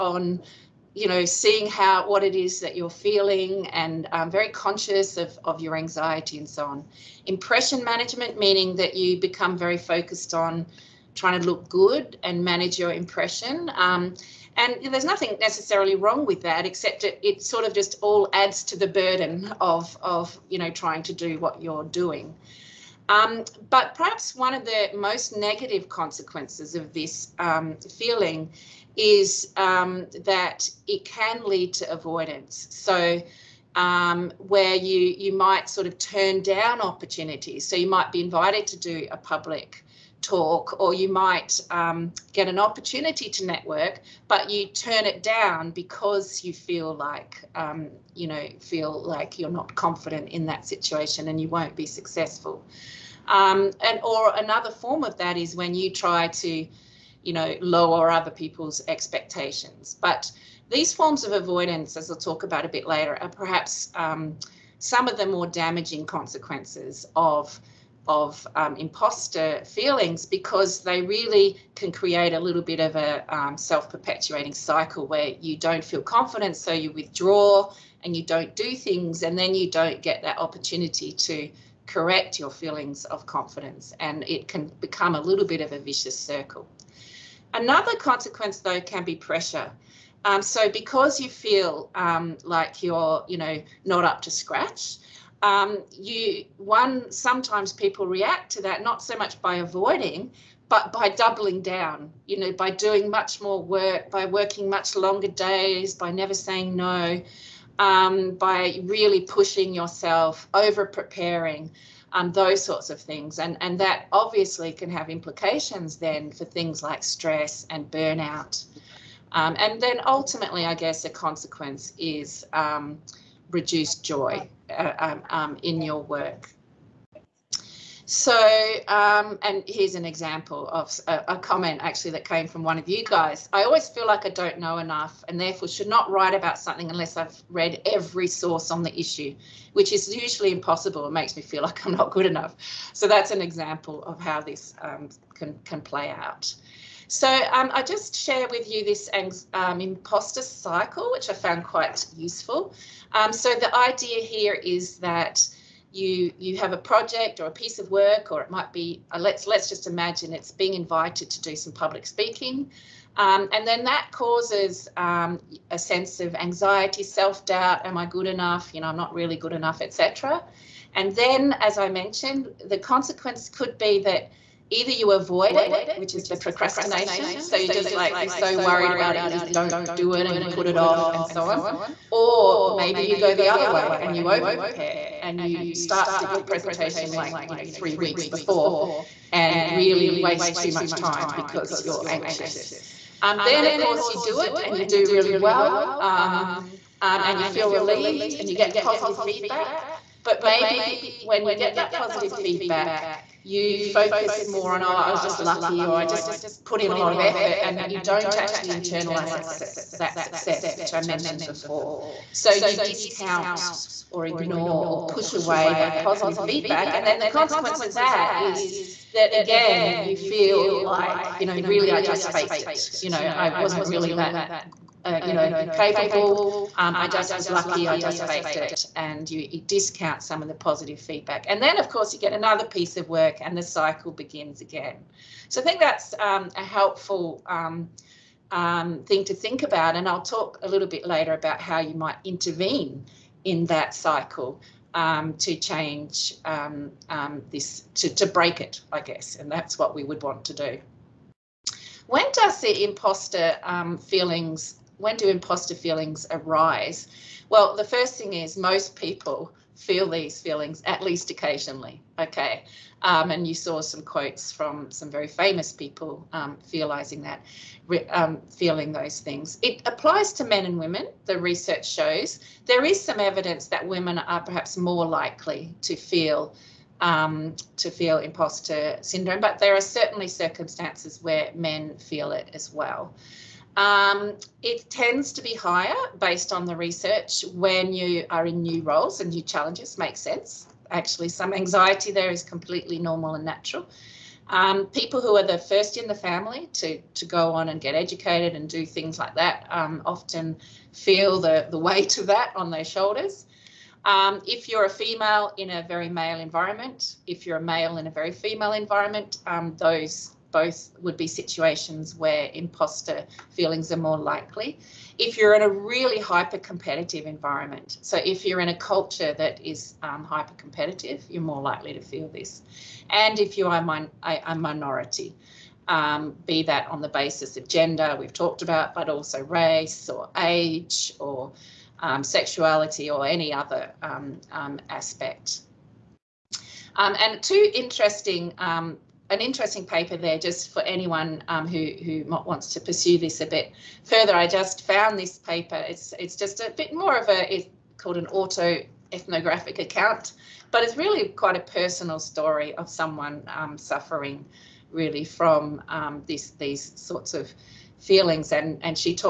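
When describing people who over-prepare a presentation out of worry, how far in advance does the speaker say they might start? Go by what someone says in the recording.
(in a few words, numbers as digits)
3 weeks.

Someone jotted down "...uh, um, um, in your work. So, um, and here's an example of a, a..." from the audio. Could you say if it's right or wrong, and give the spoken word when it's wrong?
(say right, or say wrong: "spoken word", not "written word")
right.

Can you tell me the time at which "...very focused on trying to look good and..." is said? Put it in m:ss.
0:09.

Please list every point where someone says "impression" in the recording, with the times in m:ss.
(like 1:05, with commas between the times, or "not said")
0:07, 0:12.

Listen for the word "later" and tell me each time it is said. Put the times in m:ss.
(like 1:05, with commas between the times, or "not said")
1:02, 4:01.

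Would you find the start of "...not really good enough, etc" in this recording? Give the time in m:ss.
2:48.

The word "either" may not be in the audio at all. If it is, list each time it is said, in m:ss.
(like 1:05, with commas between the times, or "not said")
2:54.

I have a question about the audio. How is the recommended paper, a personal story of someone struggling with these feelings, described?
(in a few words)
Auto ethnographic account.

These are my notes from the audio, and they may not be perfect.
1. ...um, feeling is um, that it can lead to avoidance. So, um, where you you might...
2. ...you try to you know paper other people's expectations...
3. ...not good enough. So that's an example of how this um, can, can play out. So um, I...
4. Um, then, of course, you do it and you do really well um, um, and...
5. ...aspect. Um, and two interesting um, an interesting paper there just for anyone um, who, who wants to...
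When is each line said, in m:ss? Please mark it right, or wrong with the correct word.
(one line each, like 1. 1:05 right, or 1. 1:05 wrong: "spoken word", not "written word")
1. 0:27 right
2. 0:55 wrong: "lower", not "paper"
3. 2:21 right
4. 3:13 right
5. 5:34 right.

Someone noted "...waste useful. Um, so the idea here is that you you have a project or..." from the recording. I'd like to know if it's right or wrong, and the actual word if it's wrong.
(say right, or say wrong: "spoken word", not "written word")
wrong: "quite", not "waste".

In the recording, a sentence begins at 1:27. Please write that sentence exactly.
Another consequence, though, can be pressure.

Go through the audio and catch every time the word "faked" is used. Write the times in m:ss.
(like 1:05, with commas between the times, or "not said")
3:42, 3:48.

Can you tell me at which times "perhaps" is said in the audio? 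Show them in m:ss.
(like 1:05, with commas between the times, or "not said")
0:23, 1:03, 4:34.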